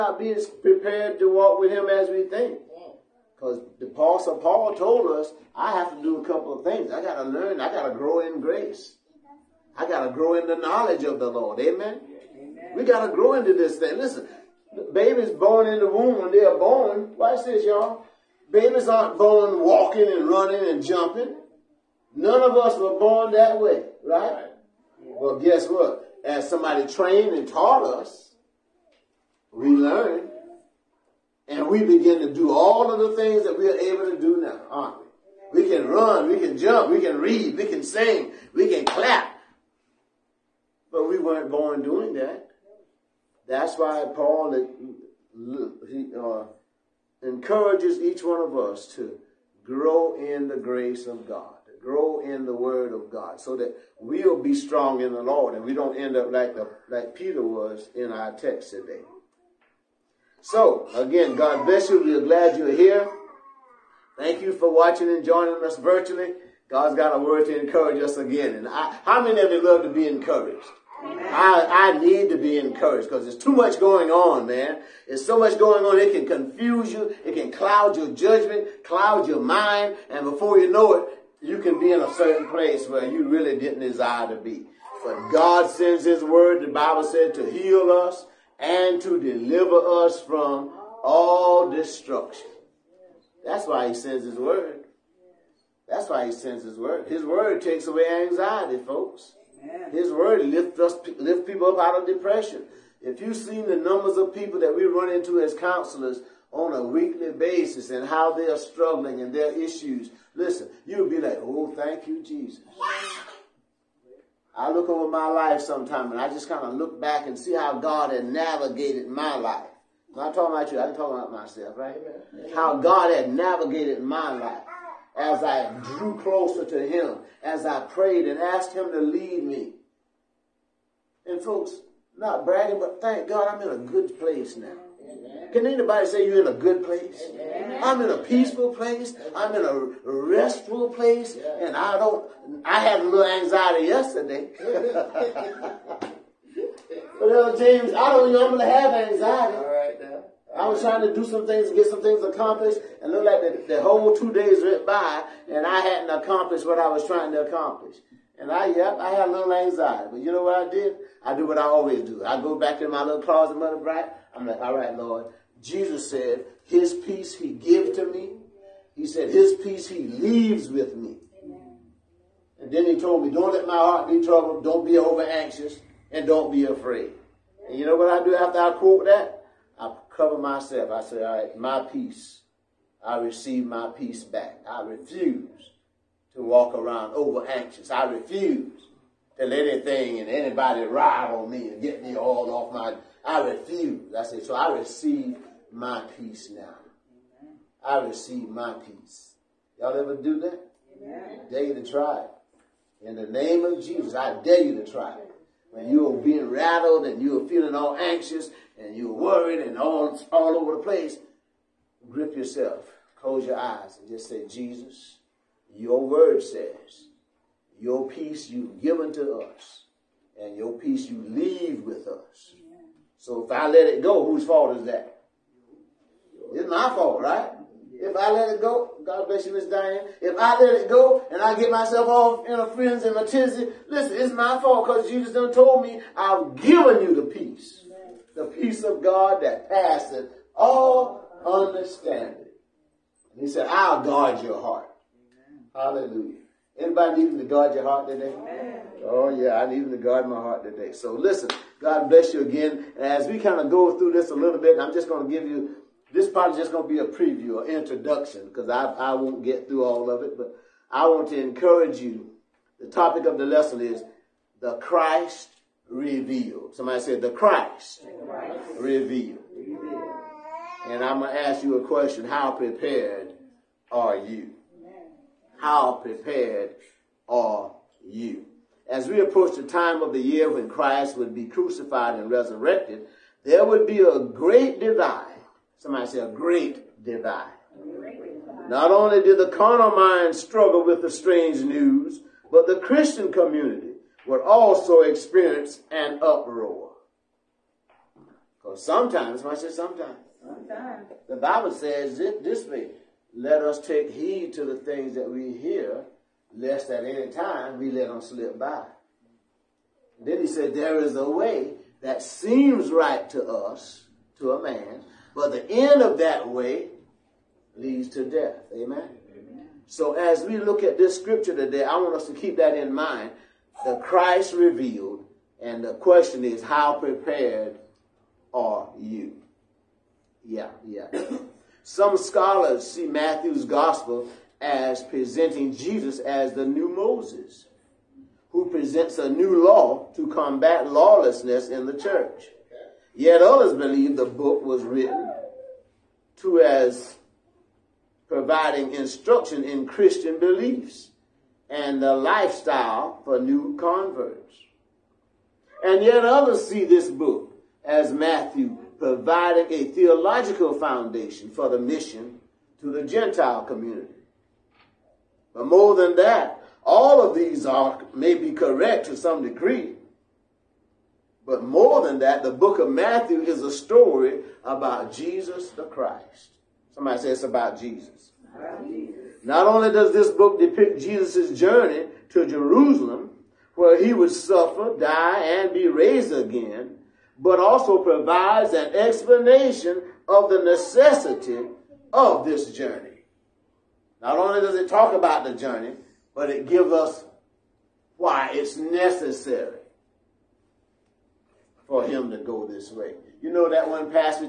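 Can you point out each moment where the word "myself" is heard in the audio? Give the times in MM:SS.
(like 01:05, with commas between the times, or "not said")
02:01, 03:00, 03:51.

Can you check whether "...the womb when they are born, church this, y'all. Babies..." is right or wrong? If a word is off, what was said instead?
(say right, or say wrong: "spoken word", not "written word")
wrong: "watch", not "church".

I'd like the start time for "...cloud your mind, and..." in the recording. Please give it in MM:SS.
01:18.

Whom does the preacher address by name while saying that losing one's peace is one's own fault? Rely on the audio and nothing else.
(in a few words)
Miss Diane.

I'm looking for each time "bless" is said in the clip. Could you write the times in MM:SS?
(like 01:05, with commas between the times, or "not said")
01:01, 03:49, 04:12.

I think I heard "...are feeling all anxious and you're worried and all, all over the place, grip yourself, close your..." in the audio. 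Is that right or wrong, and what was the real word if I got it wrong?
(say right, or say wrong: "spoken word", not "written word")
right.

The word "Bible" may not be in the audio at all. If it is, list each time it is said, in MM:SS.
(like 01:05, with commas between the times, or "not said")
01:26, 05:01.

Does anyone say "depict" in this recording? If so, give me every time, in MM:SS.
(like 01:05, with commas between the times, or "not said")
06:20.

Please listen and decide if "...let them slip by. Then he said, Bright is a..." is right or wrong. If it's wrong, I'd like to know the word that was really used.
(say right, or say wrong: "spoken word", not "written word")
wrong: "There", not "Bright".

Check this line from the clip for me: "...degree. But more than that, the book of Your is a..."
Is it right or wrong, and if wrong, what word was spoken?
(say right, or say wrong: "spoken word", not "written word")
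wrong: "Matthew", not "Your".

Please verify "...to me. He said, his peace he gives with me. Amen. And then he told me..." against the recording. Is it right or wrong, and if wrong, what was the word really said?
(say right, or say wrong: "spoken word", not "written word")
wrong: "leaves", not "gives".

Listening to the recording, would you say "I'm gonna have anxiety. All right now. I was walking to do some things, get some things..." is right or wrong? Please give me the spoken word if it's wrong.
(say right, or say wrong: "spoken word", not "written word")
wrong: "trying", not "walking".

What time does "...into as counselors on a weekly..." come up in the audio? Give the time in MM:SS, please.
01:45.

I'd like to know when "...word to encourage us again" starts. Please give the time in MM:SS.
01:07.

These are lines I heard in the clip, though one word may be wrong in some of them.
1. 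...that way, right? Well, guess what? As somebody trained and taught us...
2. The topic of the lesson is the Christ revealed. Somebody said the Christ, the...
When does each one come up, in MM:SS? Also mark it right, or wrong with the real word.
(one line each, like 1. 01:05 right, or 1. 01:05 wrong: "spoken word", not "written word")
1. 00:23 right
2. 04:22 right.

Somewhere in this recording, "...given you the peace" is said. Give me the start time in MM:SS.
03:56.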